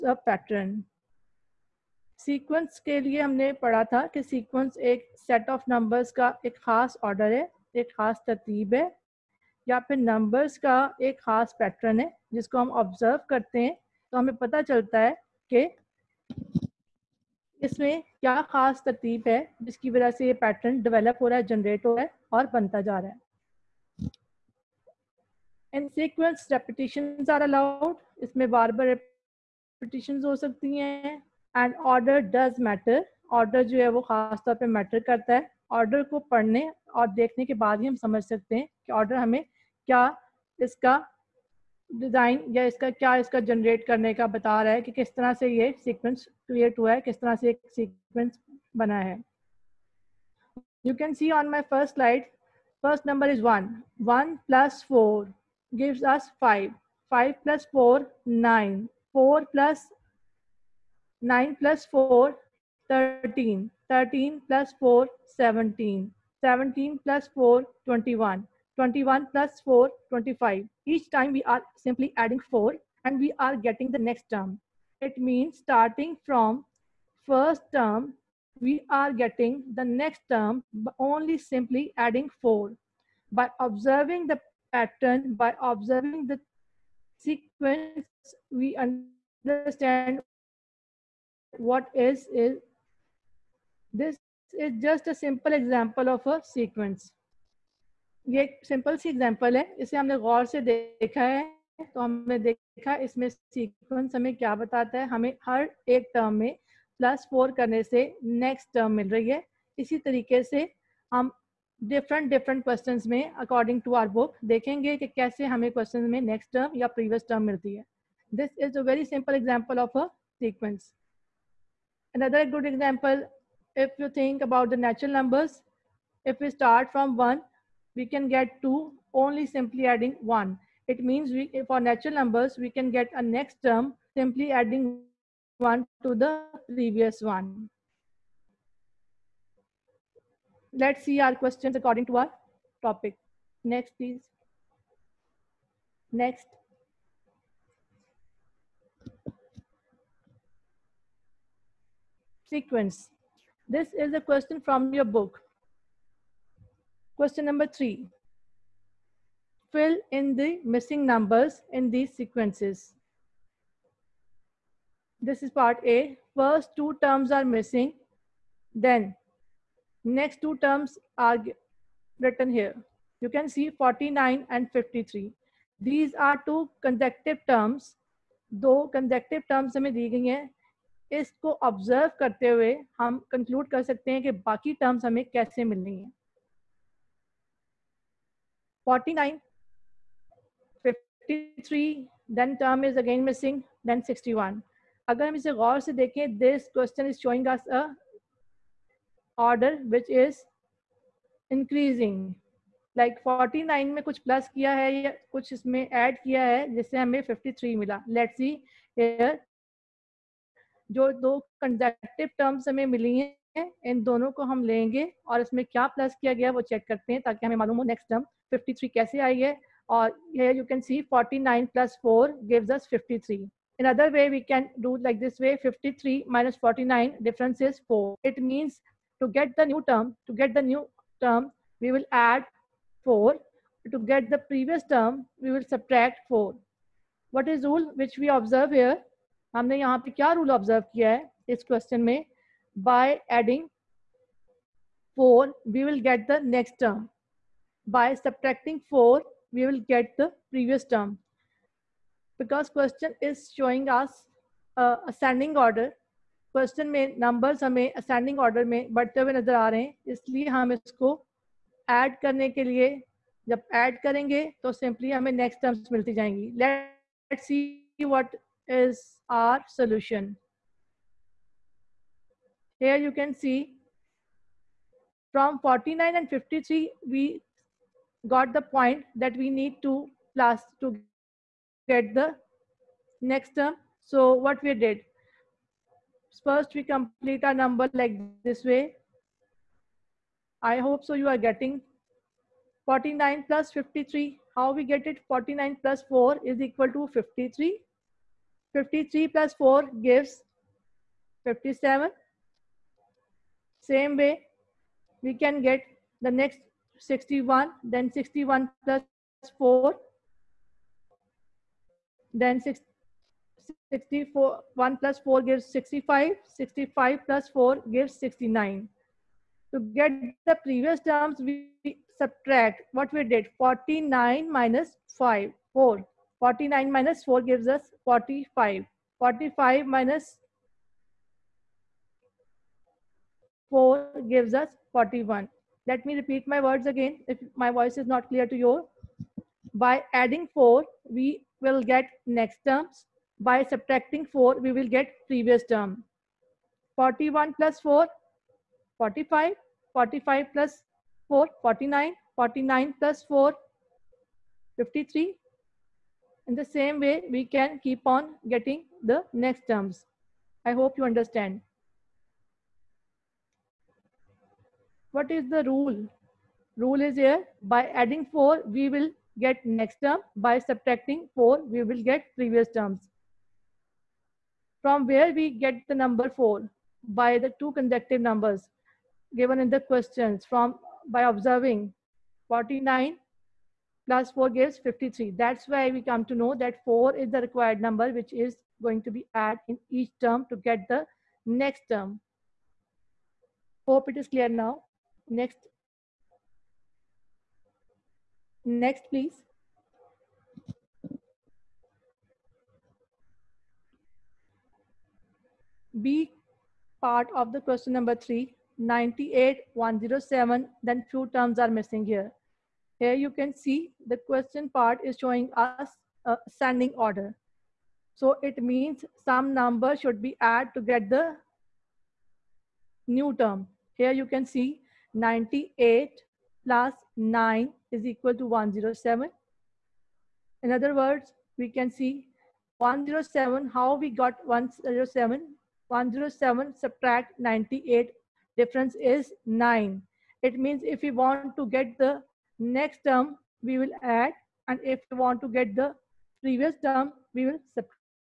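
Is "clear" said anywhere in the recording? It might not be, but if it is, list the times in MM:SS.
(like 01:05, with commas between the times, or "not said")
05:38, 06:34.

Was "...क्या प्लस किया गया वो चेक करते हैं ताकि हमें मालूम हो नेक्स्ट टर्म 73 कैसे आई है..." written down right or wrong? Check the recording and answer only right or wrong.
wrong.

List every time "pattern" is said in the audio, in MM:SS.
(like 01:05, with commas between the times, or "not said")
00:00, 01:24.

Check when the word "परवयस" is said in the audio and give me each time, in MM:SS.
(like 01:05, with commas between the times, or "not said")
01:56, 03:54.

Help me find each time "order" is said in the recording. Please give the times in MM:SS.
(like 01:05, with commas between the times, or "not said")
04:15, 06:56.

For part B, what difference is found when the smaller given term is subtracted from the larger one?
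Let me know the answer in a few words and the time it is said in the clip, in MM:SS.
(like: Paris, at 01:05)
9, at 07:18.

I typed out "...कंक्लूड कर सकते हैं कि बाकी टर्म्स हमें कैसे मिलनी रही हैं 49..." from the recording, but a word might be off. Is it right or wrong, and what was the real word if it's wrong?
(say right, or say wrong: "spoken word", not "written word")
right.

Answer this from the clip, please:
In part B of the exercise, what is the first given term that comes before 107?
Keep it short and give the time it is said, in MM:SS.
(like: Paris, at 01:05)
98, at 06:48.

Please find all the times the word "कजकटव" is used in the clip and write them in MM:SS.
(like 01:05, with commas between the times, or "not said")
02:58, 03:31.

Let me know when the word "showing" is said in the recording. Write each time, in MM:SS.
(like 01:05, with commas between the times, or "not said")
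04:13, 06:55.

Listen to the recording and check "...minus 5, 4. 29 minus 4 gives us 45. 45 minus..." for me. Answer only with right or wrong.
wrong.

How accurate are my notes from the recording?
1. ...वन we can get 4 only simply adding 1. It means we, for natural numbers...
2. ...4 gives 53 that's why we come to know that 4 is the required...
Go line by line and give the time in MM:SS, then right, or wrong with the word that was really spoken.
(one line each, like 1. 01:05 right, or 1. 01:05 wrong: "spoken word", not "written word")
1. 02:07 wrong: "2", not "4"
2. 06:24 right.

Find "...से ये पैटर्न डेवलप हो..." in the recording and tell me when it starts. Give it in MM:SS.
00:20.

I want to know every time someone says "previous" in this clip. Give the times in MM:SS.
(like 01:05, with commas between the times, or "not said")
02:16, 04:10, 05:20, 05:45, 06:12, 07:26.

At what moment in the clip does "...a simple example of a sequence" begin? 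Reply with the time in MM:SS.
01:35.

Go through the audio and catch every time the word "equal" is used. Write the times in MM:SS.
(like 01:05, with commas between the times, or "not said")
04:56, 07:08.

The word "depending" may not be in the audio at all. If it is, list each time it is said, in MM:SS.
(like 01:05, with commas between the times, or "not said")
not said.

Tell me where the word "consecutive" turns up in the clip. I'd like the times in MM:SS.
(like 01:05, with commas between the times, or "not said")
02:56, 06:17.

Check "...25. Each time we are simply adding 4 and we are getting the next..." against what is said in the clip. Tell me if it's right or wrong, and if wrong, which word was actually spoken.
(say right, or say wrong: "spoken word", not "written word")
right.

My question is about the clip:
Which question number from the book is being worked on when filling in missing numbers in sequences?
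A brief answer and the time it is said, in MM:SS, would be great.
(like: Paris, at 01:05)
3, at 02:37.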